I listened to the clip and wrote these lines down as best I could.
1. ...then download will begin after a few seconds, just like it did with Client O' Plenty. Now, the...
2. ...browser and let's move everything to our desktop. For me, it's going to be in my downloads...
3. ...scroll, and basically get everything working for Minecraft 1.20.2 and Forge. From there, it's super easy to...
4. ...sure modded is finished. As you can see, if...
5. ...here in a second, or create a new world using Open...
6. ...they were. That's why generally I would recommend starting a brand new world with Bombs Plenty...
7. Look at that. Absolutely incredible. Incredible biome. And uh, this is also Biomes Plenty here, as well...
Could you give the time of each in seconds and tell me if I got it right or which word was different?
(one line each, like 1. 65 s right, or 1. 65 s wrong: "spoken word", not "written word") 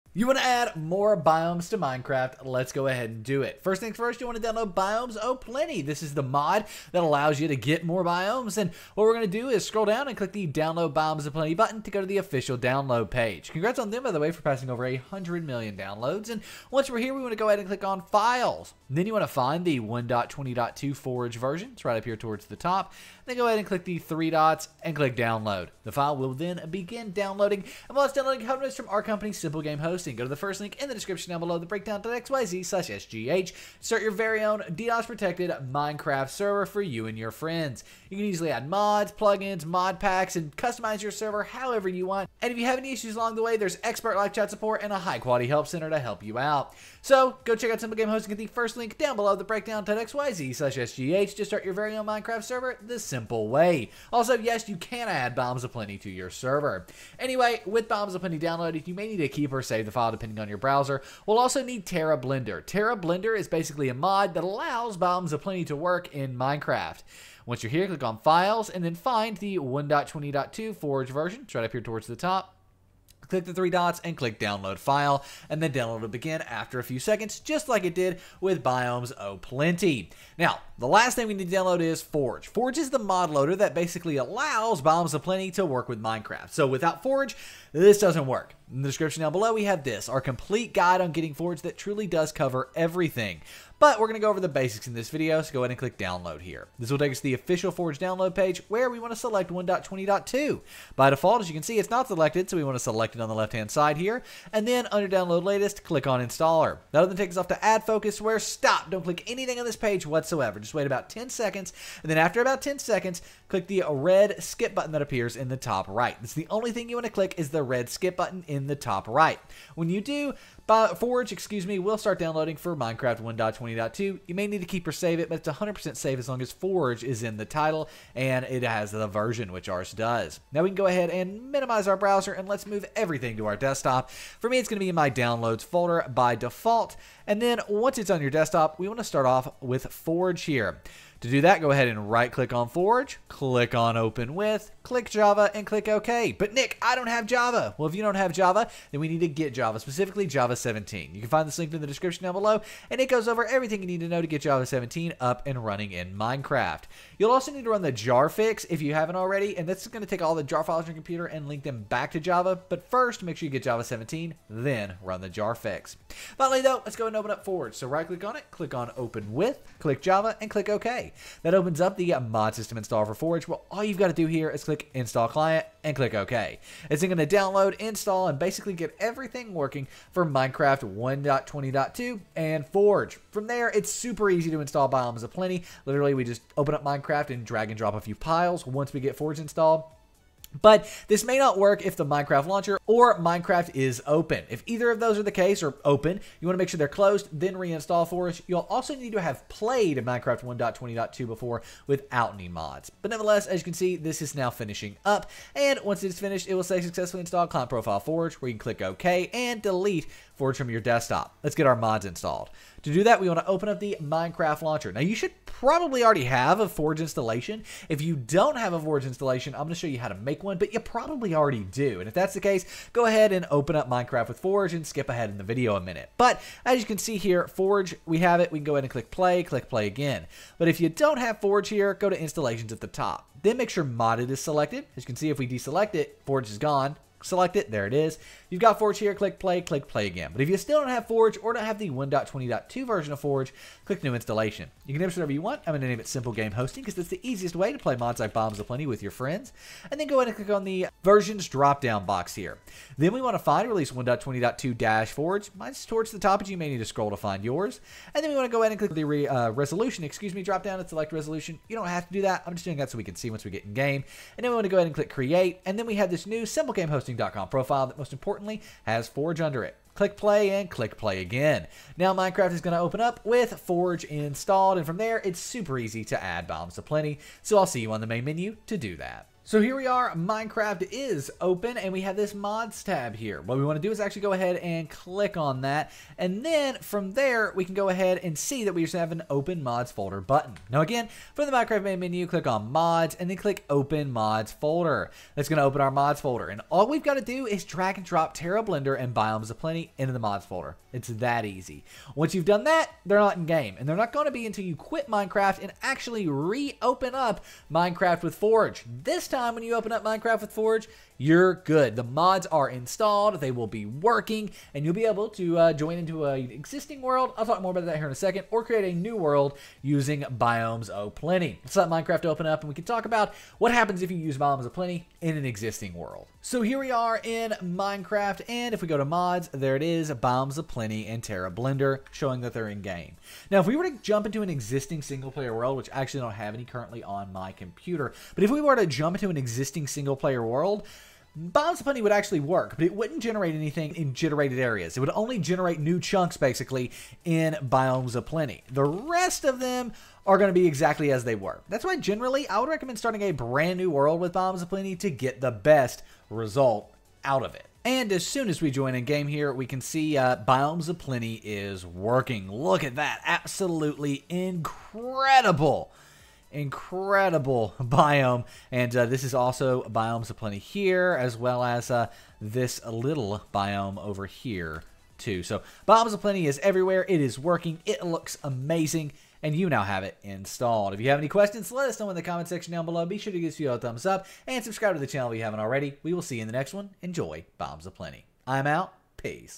1. 75 s wrong: "Biomes", not "Client"
2. 131 s right
3. 177 s wrong: "install", not "scroll"
4. 233 s wrong: "selected", not "finished"
5. 317 s wrong: "Biomes", not "Open"
6. 351 s right
7. 362 s right.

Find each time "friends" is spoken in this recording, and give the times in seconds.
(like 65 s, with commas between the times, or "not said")
37 s, 249 s.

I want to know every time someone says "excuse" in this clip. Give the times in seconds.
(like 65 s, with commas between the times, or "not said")
121 s, 260 s.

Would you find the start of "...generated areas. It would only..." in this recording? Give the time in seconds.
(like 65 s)
344 s.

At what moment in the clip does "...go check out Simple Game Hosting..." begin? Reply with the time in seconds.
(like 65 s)
47 s.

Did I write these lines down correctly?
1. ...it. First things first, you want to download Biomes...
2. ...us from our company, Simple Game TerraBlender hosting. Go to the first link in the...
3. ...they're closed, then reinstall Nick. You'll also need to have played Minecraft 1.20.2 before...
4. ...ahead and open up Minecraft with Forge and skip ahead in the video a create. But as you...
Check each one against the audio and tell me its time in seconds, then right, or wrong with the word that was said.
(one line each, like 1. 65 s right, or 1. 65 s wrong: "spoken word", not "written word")
1. 3 s right
2. 28 s wrong: "Host", not "TerraBlender"
3. 196 s wrong: "Forge", not "Nick"
4. 223 s wrong: "minute", not "create".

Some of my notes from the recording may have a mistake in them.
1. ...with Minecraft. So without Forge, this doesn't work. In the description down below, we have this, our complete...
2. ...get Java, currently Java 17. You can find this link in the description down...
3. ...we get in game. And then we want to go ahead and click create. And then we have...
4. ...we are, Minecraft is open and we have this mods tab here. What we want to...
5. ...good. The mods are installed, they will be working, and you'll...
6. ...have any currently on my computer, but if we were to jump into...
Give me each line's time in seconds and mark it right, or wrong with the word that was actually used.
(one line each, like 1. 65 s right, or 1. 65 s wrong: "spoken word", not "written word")
1. 85 s right
2. 149 s wrong: "specifically", not "currently"
3. 263 s right
4. 279 s right
5. 311 s right
6. 336 s right.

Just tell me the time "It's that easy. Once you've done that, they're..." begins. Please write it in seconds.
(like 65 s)
300 s.